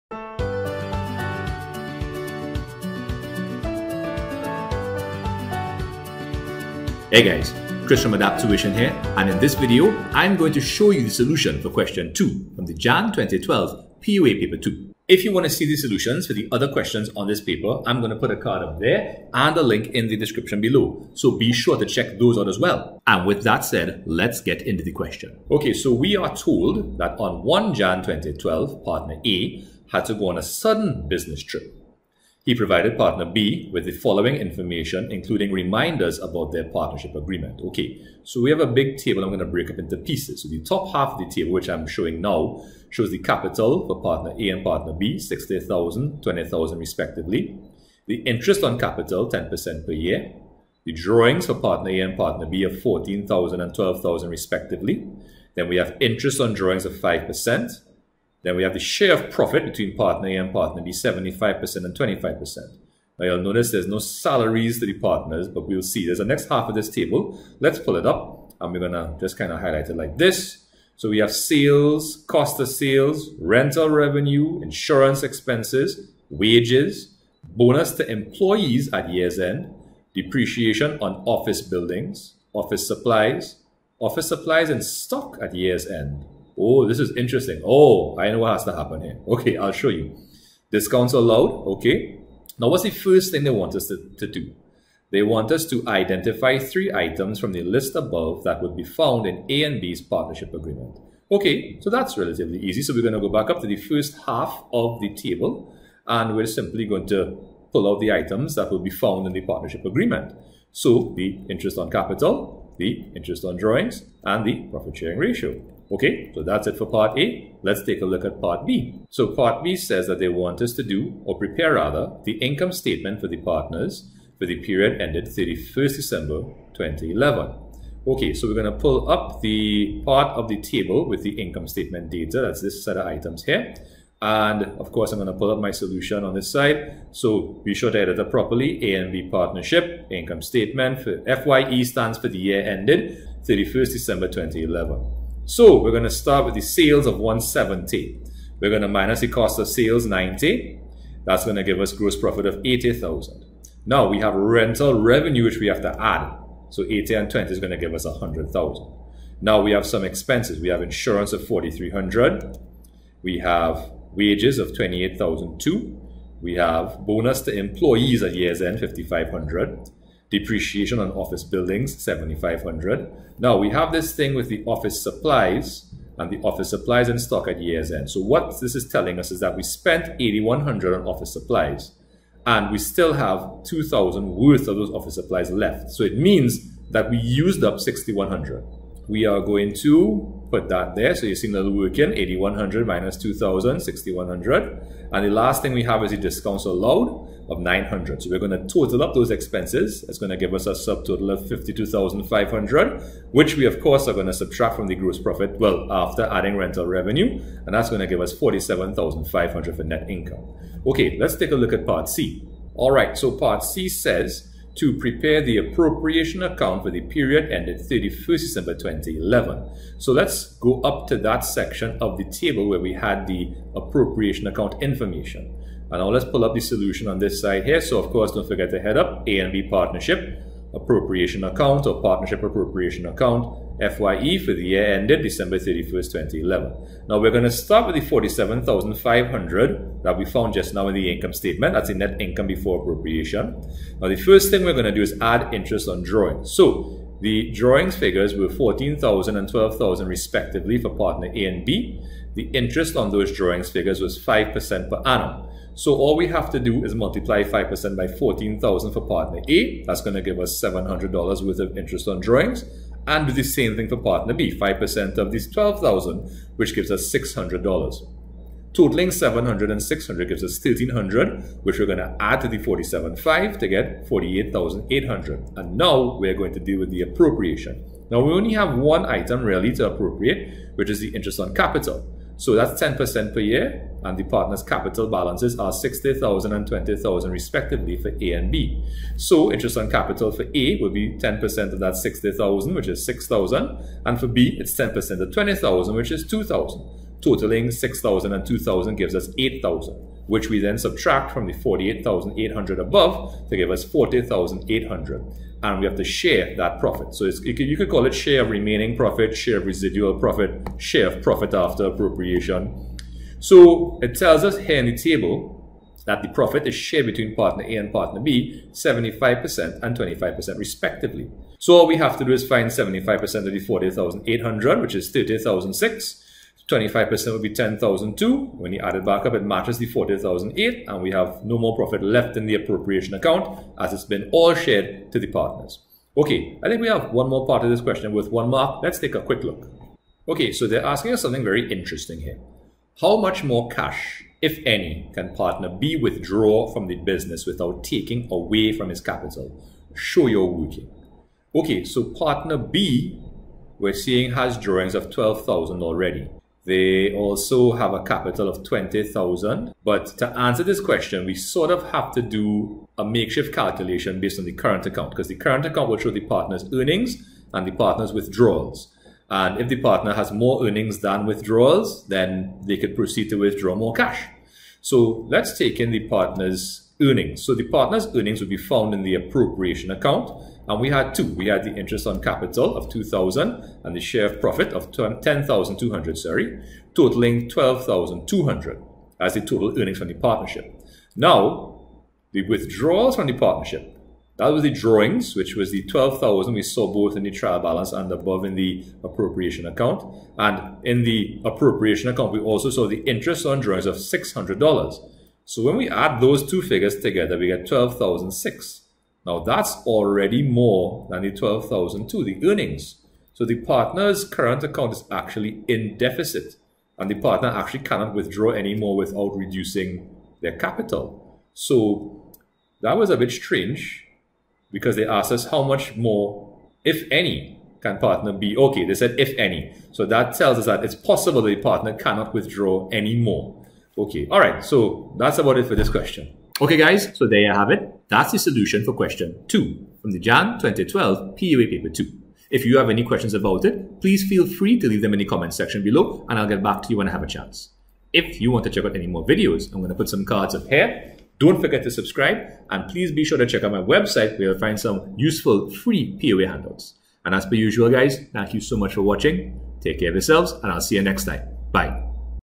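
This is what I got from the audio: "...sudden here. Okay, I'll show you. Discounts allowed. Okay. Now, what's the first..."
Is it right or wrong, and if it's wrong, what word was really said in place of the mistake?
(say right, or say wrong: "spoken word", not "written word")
wrong: "happen", not "sudden".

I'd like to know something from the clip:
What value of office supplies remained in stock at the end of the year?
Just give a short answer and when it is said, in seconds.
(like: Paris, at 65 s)
2,000, at 183 s.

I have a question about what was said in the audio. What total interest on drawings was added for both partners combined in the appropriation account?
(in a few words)
1,300.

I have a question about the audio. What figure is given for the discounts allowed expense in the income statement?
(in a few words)
900.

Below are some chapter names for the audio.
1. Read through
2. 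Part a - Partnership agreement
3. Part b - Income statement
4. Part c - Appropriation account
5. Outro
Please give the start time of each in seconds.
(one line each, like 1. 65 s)
1. 25 s
2. 92 s
3. 119 s
4. 212 s
5. 436 s.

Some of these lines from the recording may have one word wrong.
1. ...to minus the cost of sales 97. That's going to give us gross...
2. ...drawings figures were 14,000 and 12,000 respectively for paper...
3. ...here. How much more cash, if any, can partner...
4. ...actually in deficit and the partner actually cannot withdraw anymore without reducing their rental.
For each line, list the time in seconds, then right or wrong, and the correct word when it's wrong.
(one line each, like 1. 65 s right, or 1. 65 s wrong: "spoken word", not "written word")
1. 148 s wrong: "90", not "97"
2. 247 s wrong: "partner", not "paper"
3. 342 s right
4. 415 s wrong: "capital", not "rental".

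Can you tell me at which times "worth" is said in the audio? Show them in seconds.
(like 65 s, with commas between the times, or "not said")
184 s, 261 s.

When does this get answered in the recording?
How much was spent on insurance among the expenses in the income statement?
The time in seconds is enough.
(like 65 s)
161 s.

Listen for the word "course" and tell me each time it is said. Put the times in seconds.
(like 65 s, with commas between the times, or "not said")
134 s, 203 s, 228 s.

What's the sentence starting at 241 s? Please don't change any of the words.
That's the net income before appropriation.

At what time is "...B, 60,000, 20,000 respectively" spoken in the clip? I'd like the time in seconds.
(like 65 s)
44 s.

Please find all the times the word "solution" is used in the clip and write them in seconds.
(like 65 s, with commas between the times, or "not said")
11 s, 15 s, 135 s, 226 s, 438 s.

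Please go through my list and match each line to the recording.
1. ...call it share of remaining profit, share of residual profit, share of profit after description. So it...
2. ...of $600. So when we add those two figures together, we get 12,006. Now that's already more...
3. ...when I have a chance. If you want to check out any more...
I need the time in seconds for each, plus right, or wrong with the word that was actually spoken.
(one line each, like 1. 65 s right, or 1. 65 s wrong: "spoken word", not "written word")
1. 307 s wrong: "appropriation", not "description"
2. 403 s right
3. 446 s right.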